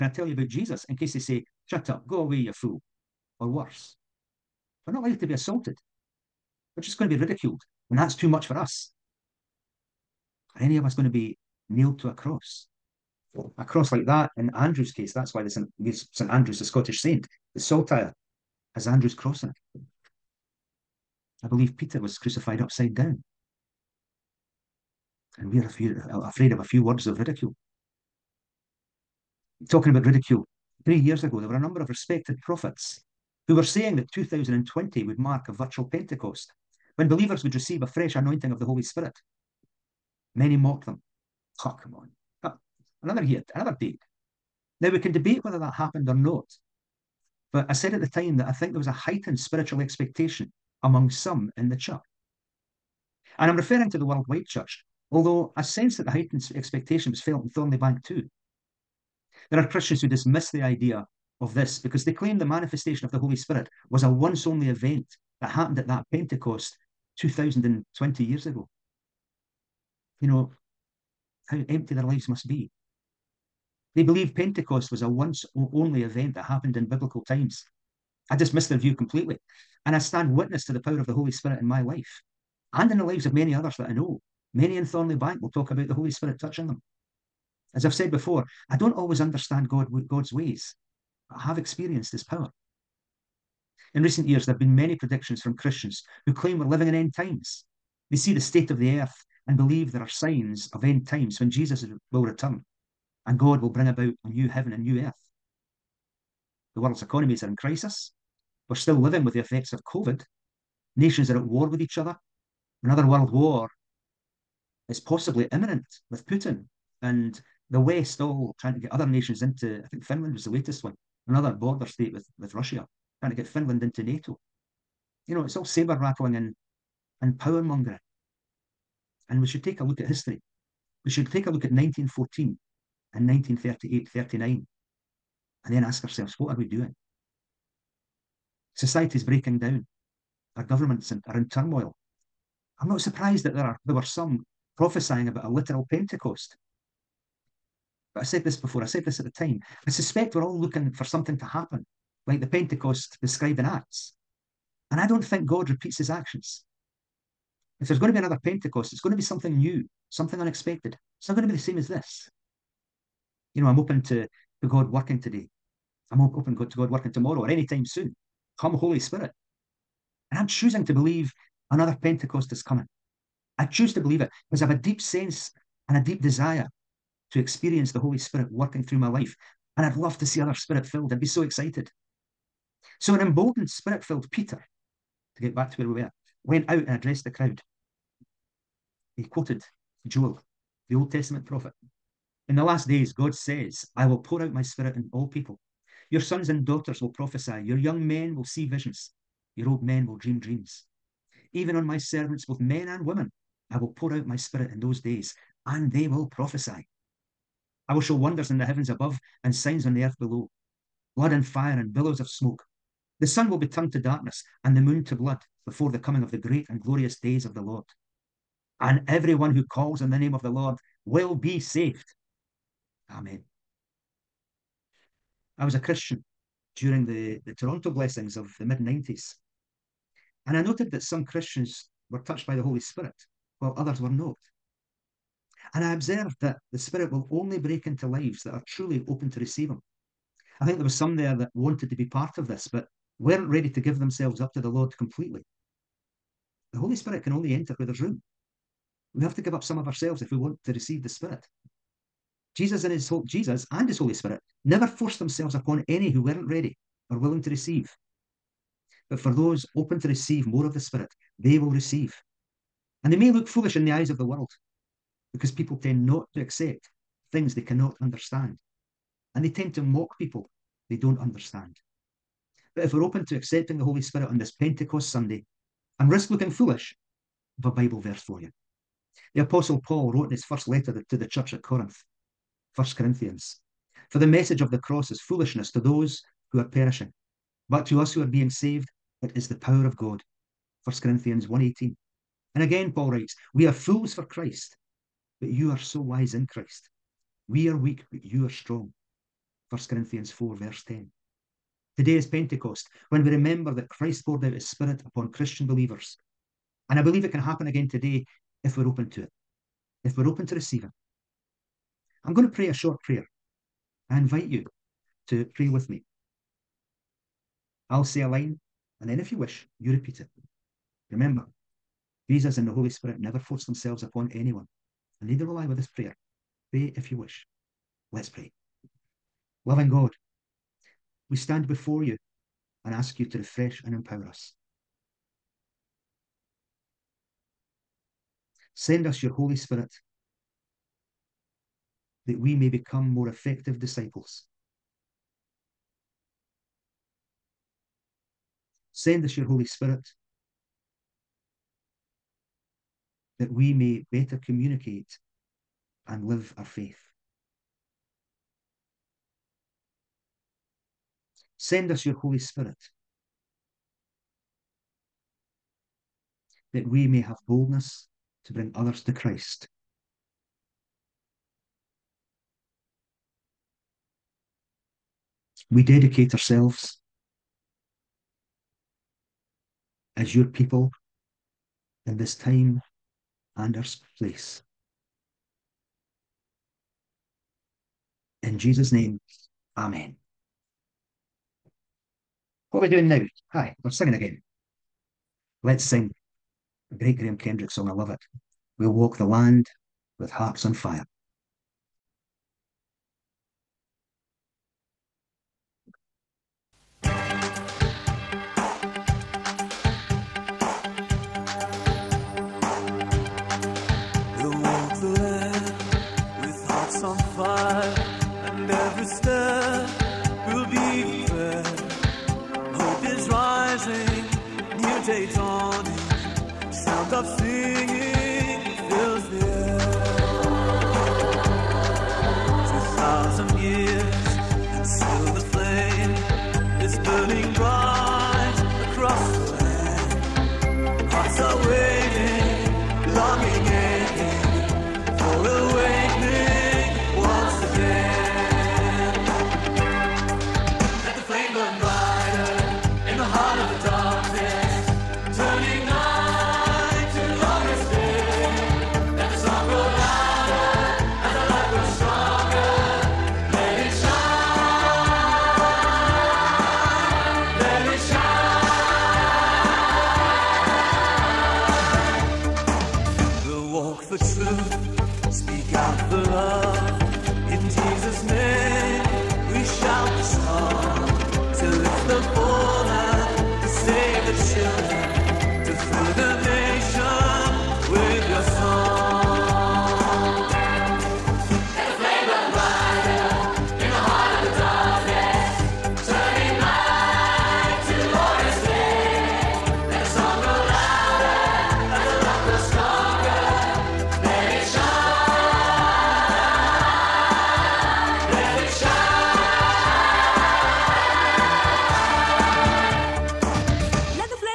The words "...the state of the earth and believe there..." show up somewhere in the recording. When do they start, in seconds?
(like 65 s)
98 s.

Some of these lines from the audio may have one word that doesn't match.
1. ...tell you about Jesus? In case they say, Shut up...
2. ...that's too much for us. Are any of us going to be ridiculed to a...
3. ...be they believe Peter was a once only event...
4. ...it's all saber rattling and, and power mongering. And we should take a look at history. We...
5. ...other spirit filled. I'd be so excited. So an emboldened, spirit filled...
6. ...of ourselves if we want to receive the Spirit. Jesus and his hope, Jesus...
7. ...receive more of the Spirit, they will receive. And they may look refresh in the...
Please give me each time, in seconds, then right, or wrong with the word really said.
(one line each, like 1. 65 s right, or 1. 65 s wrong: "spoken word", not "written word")
1. 0 s right
2. 7 s wrong: "nailed", not "ridiculed"
3. 72 s wrong: "Pentecost", not "Peter"
4. 125 s right
5. 180 s right
6. 249 s right
7. 260 s wrong: "foolish", not "refresh".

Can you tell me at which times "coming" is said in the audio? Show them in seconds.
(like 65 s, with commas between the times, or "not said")
172 s, 215 s.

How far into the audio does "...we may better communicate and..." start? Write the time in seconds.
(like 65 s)
353 s.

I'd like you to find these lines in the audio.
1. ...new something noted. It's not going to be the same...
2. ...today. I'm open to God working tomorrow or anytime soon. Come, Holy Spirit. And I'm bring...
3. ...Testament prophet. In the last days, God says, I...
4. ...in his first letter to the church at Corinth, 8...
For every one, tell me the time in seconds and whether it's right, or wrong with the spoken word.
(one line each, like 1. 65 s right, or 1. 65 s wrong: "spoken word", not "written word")
1. 159 s wrong: "unexpected", not "noted"
2. 165 s wrong: "choosing", not "bring"
3. 191 s right
4. 280 s wrong: "1", not "8".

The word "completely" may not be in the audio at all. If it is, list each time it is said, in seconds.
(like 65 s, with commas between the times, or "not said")
78 s, 244 s.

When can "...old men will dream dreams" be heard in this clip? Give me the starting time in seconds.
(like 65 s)
199 s.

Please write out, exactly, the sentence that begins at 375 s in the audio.
we dedicate ourselves as your people in this time and our place.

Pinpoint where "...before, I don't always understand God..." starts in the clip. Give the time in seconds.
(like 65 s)
88 s.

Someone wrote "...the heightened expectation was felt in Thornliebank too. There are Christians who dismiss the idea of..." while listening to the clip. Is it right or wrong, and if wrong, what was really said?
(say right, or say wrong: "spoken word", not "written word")
right.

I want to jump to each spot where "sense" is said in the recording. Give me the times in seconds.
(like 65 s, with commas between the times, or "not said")
55 s, 174 s.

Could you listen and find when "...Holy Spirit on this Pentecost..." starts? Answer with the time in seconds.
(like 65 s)
273 s.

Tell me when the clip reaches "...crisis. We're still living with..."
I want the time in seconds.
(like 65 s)
107 s.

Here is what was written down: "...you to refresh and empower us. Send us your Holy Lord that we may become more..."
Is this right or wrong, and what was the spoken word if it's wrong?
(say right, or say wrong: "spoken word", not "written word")
wrong: "Spirit", not "Lord".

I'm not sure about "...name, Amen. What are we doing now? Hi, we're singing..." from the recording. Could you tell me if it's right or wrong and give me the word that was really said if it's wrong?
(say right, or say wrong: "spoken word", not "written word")
right.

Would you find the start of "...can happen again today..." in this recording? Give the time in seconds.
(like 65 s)
307 s.